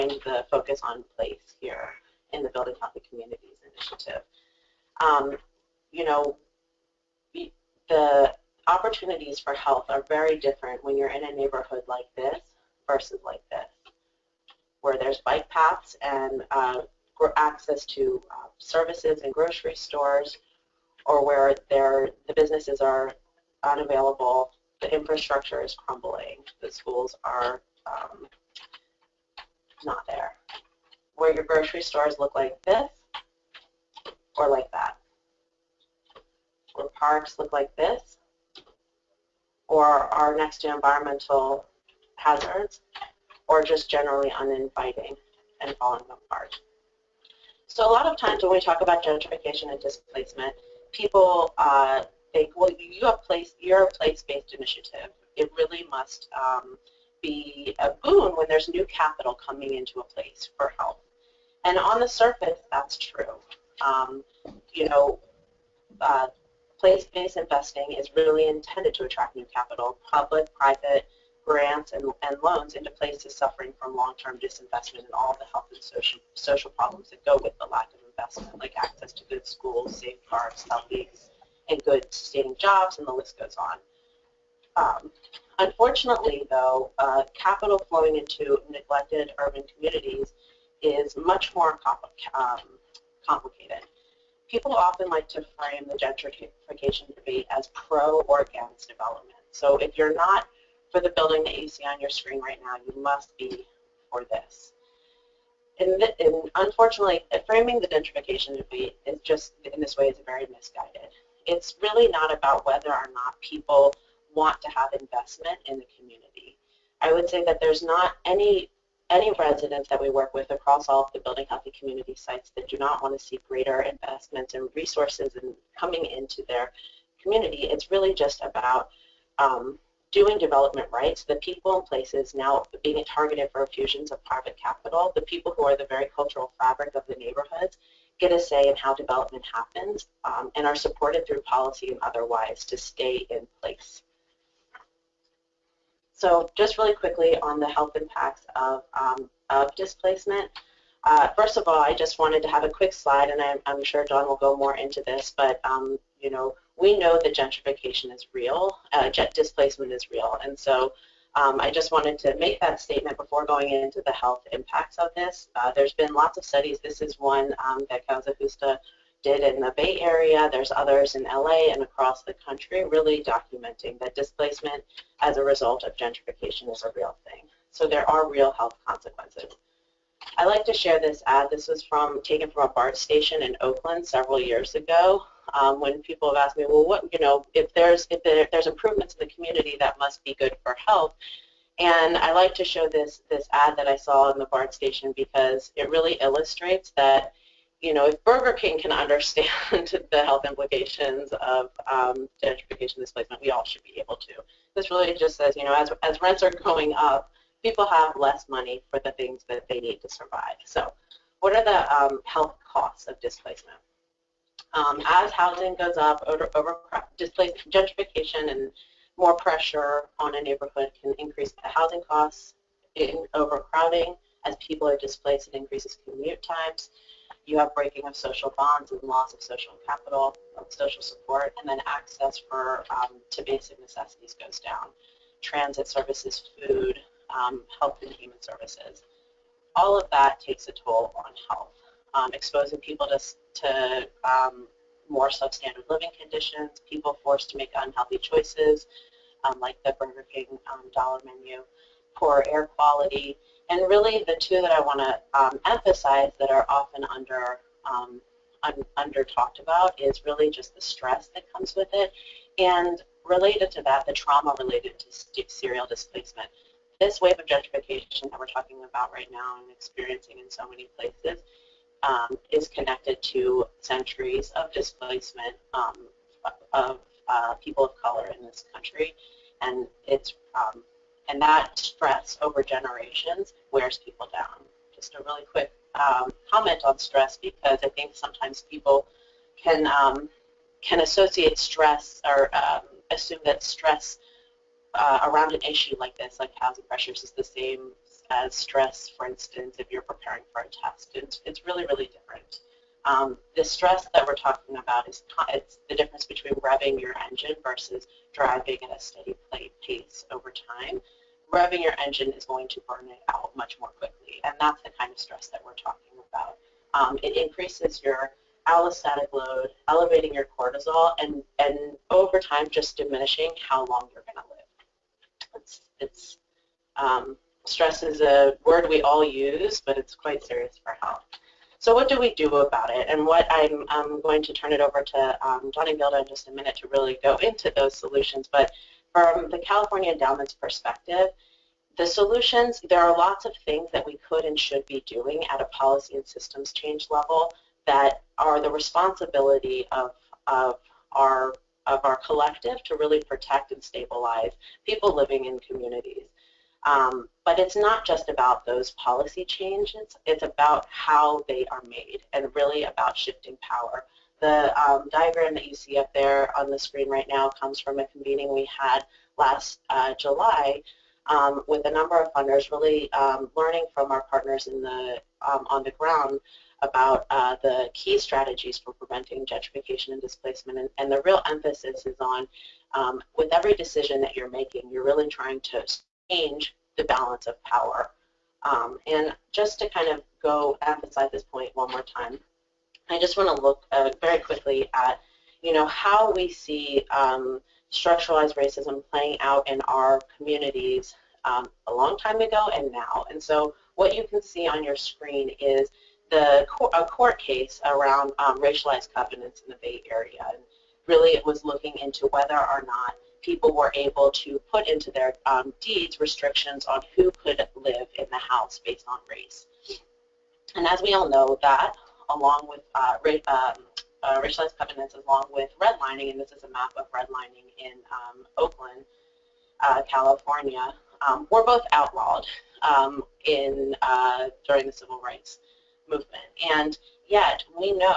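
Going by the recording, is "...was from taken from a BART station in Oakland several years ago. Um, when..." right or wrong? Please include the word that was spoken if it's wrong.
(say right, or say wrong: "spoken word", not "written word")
right.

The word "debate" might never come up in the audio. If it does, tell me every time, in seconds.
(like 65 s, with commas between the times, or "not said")
97 s, 108 s.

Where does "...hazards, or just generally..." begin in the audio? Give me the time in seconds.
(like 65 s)
42 s.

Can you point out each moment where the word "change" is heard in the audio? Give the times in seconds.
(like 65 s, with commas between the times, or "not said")
346 s, 359 s, 386 s.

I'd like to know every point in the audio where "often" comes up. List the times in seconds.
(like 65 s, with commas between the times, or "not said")
94 s, 256 s.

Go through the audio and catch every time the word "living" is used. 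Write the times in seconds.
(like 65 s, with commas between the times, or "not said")
245 s, 355 s.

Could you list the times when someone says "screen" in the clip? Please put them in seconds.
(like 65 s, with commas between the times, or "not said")
102 s, 366 s, 404 s.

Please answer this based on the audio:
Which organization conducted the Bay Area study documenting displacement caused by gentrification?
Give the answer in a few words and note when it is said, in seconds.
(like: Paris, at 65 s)
Causa, at 168 s.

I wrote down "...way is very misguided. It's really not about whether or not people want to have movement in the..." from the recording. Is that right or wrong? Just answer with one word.
wrong.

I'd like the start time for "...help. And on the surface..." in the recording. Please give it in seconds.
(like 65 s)
60 s.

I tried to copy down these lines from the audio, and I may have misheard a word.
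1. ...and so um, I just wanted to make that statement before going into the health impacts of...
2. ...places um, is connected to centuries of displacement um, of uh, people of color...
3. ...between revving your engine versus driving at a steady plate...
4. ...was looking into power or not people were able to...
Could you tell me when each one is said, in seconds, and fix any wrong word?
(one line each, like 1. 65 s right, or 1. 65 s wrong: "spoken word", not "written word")
1. 160 s right
2. 270 s right
3. 306 s right
4. 411 s wrong: "whether", not "power".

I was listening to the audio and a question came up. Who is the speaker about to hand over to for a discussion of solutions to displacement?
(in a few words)
Johnny Gilda.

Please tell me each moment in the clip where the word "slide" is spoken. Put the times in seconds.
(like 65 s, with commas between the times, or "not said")
152 s.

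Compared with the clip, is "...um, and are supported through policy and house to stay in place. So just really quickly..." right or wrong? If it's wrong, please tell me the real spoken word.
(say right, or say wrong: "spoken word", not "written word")
wrong: "otherwise", not "house".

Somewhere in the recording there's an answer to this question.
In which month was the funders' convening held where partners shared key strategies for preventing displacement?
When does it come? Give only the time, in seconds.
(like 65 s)
370 s.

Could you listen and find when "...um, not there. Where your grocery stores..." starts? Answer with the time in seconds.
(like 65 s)
27 s.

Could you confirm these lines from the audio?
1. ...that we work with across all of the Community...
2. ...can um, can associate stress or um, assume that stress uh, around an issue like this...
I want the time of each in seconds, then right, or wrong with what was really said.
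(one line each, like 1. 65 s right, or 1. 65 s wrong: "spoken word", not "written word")
1. 119 s wrong: "Building", not "Community"
2. 289 s right.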